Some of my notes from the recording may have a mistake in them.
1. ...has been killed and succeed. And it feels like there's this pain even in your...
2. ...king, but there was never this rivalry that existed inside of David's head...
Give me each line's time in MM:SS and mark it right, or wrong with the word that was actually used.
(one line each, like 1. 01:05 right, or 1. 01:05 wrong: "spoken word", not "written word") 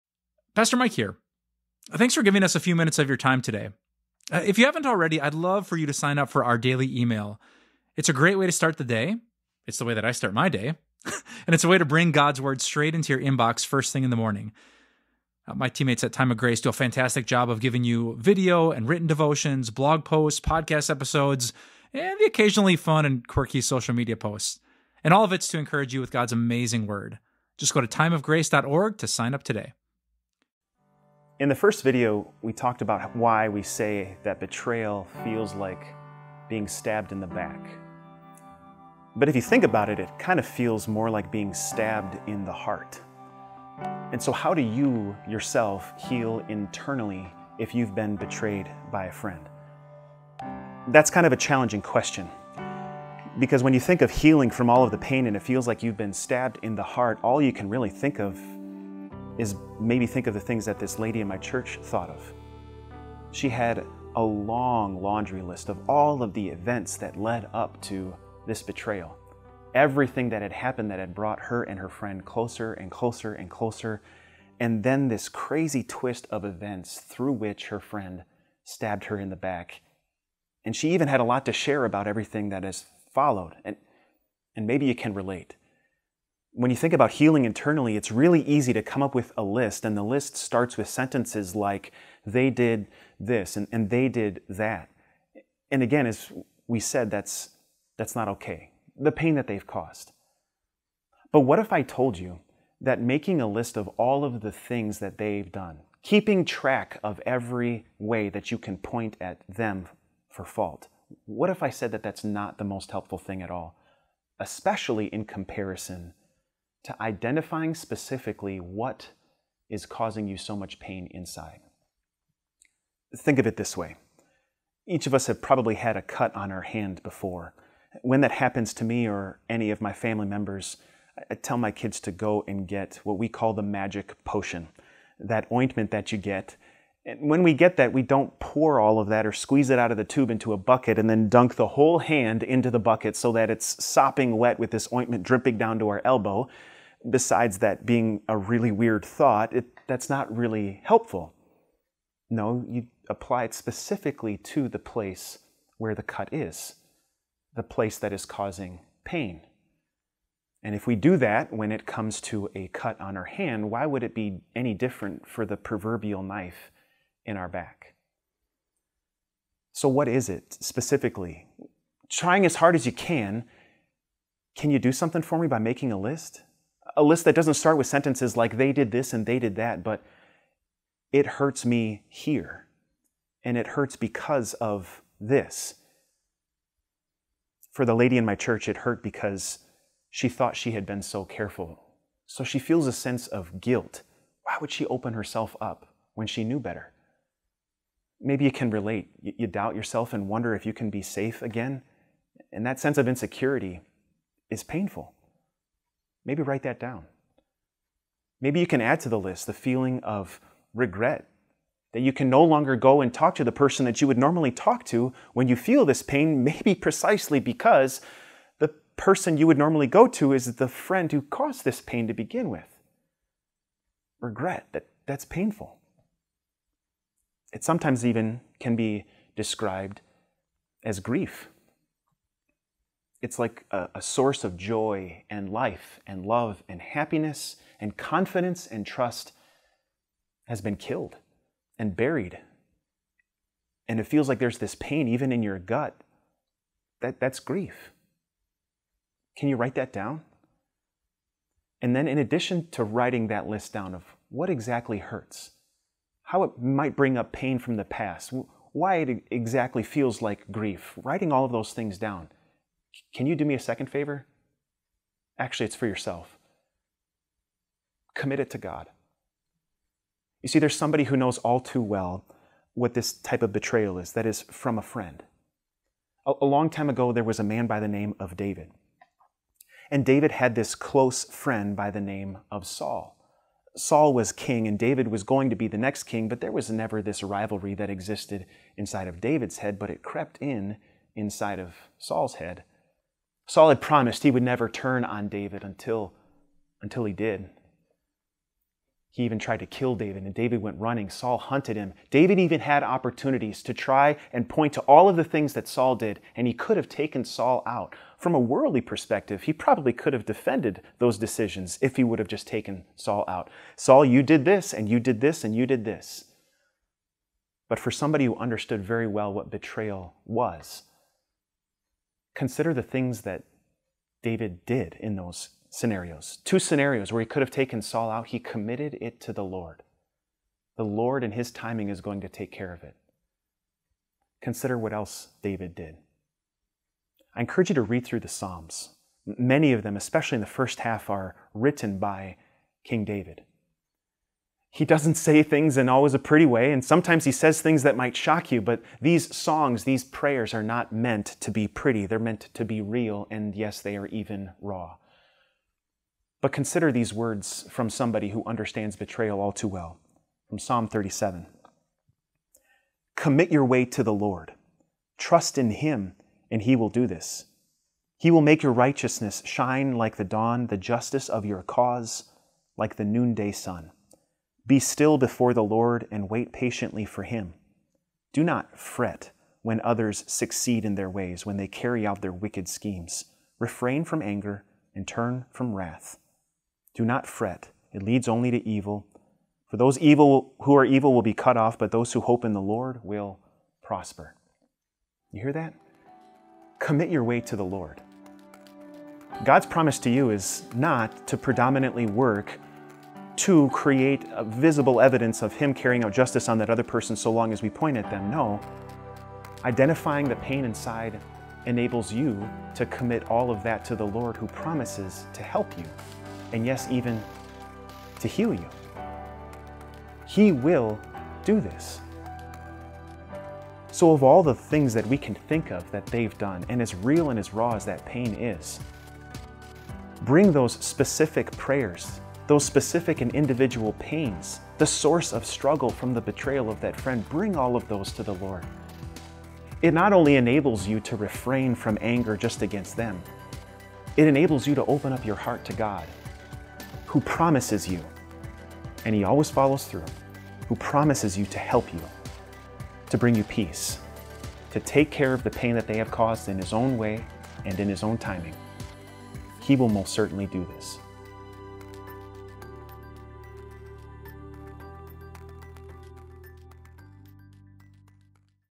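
1. 04:00 wrong: "buried", not "succeed"
2. 04:46 right.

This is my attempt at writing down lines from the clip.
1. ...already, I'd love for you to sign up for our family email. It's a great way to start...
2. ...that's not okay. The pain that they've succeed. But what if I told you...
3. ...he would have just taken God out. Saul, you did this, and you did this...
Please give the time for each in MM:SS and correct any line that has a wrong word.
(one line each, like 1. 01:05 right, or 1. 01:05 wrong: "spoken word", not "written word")
1. 00:04 wrong: "daily", not "family"
2. 01:37 wrong: "caused", not "succeed"
3. 05:11 wrong: "Saul", not "God".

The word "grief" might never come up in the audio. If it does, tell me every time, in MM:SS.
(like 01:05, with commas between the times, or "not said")
03:50, 04:07, 04:20.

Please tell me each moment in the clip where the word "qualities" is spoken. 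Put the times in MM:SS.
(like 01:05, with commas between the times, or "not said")
not said.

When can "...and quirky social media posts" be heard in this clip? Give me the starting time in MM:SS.
00:23.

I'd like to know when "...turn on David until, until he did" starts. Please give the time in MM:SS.
04:54.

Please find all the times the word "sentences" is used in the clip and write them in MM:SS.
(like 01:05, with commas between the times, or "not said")
01:30, 02:57.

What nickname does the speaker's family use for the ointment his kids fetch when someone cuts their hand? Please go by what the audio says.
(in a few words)
magic potion.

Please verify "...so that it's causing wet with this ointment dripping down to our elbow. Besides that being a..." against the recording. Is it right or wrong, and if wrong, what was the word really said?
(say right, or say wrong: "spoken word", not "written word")
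wrong: "sopping", not "causing".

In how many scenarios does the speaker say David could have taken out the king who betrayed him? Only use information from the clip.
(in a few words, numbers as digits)
2.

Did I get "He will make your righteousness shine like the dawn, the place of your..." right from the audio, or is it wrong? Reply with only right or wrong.
wrong.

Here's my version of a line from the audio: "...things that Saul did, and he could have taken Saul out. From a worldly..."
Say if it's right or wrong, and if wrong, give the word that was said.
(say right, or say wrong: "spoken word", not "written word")
right.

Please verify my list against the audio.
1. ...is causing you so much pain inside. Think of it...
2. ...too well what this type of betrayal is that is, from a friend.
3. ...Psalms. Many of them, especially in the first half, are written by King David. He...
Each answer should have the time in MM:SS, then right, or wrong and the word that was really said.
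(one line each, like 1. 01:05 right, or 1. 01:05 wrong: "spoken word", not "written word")
1. 01:59 right
2. 04:31 right
3. 05:38 right.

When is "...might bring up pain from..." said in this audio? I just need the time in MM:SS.
04:16.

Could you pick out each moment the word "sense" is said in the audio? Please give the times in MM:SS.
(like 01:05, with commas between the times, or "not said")
03:12, 03:22.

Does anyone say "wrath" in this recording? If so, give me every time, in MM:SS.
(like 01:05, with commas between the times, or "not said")
06:25.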